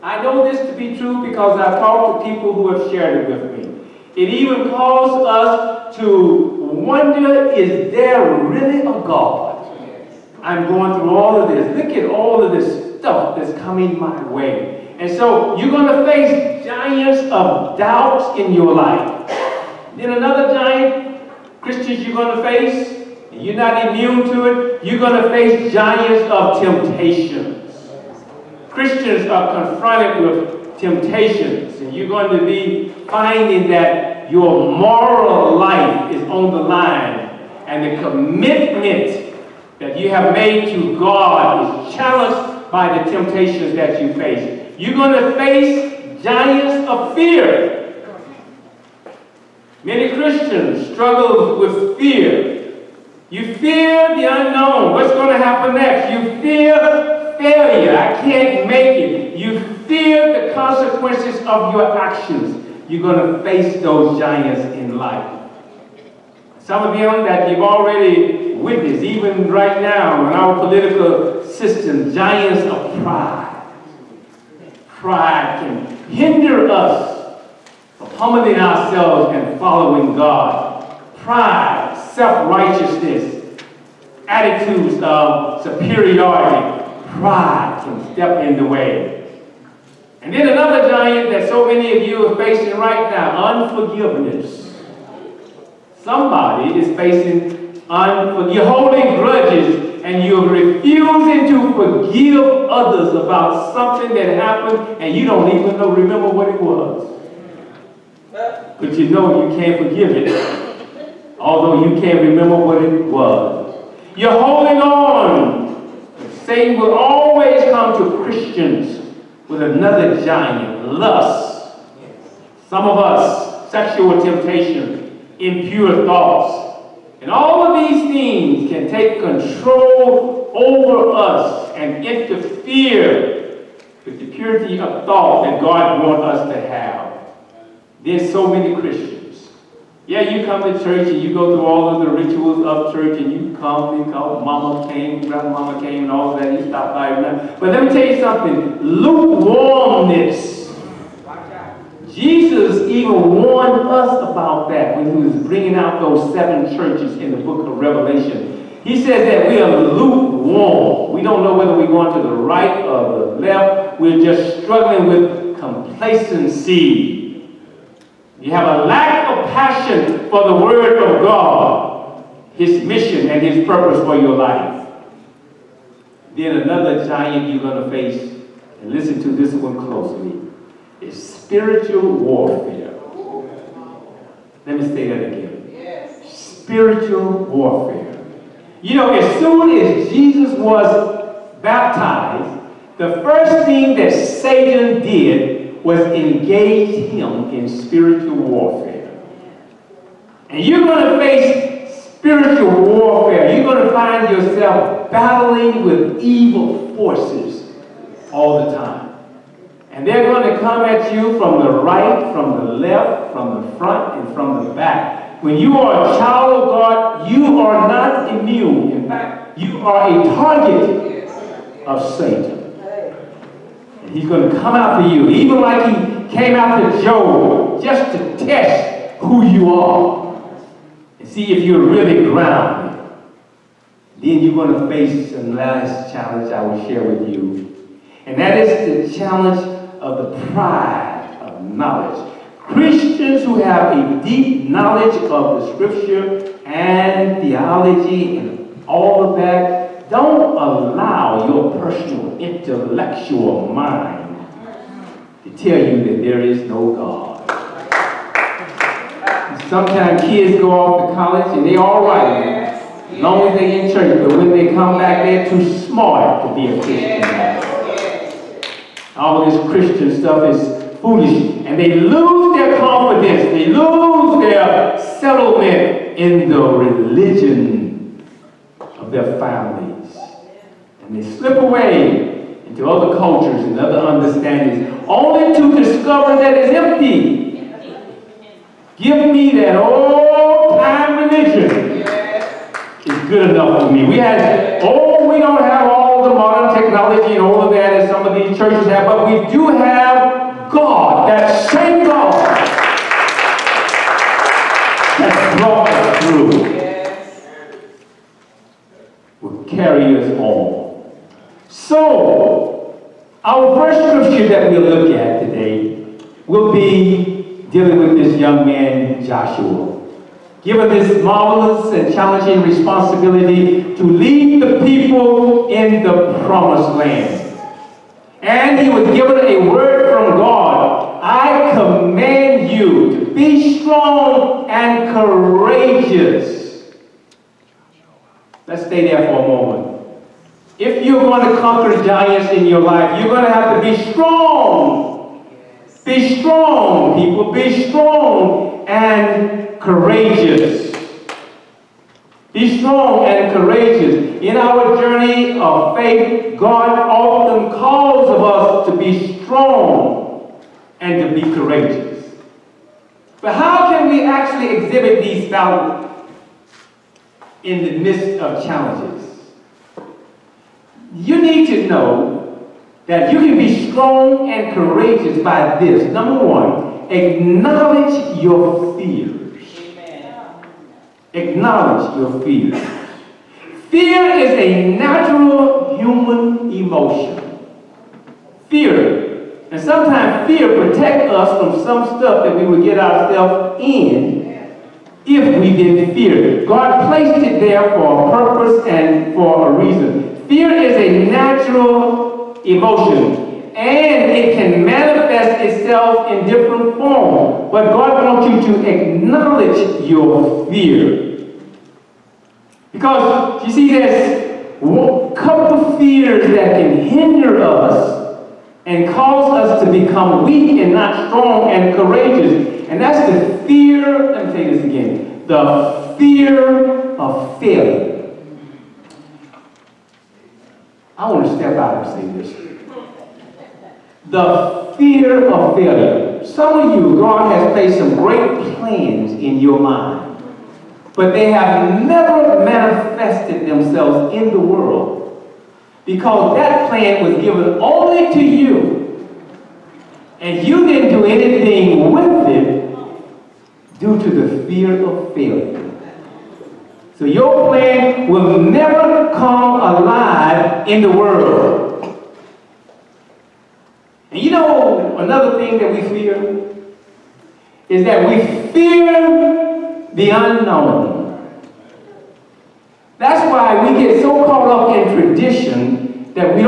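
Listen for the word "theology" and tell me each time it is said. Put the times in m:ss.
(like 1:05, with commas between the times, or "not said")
4:07.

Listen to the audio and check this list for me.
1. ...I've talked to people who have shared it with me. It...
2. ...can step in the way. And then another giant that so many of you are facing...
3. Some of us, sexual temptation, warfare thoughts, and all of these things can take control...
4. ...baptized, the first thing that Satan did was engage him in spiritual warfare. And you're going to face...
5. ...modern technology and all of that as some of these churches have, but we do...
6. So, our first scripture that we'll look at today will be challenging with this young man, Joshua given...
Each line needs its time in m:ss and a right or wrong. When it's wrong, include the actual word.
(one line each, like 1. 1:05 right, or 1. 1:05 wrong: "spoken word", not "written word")
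1. 0:01 right
2. 1:27 right
3. 2:02 wrong: "impure", not "warfare"
4. 3:11 right
5. 4:56 right
6. 5:11 wrong: "dealing", not "challenging".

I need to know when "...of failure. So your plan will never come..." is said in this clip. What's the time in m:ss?
7:35.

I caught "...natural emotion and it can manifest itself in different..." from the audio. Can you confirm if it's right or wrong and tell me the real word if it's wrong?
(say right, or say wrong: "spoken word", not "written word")
right.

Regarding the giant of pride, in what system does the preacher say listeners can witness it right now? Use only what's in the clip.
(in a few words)
Political system.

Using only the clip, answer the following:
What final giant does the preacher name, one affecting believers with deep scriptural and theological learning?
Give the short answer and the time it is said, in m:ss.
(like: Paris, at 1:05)
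Pride of knowledge, at 4:00.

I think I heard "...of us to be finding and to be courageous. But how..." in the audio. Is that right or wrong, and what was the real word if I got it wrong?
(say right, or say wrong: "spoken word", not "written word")
wrong: "strong", not "finding".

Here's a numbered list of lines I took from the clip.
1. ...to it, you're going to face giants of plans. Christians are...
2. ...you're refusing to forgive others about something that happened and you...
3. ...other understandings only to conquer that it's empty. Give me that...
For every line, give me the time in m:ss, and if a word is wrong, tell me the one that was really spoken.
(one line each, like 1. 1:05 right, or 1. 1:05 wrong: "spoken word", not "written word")
1. 0:24 wrong: "temptations", not "plans"
2. 1:40 right
3. 4:43 wrong: "discover", not "conquer".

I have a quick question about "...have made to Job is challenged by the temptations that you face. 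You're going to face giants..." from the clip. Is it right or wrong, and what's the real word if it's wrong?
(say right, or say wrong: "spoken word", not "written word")
wrong: "God", not "Job".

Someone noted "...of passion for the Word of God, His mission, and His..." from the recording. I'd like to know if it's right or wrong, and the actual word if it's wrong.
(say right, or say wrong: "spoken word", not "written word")
right.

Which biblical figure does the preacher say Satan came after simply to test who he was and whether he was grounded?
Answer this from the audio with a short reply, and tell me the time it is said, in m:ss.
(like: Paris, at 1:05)
Job, at 3:47.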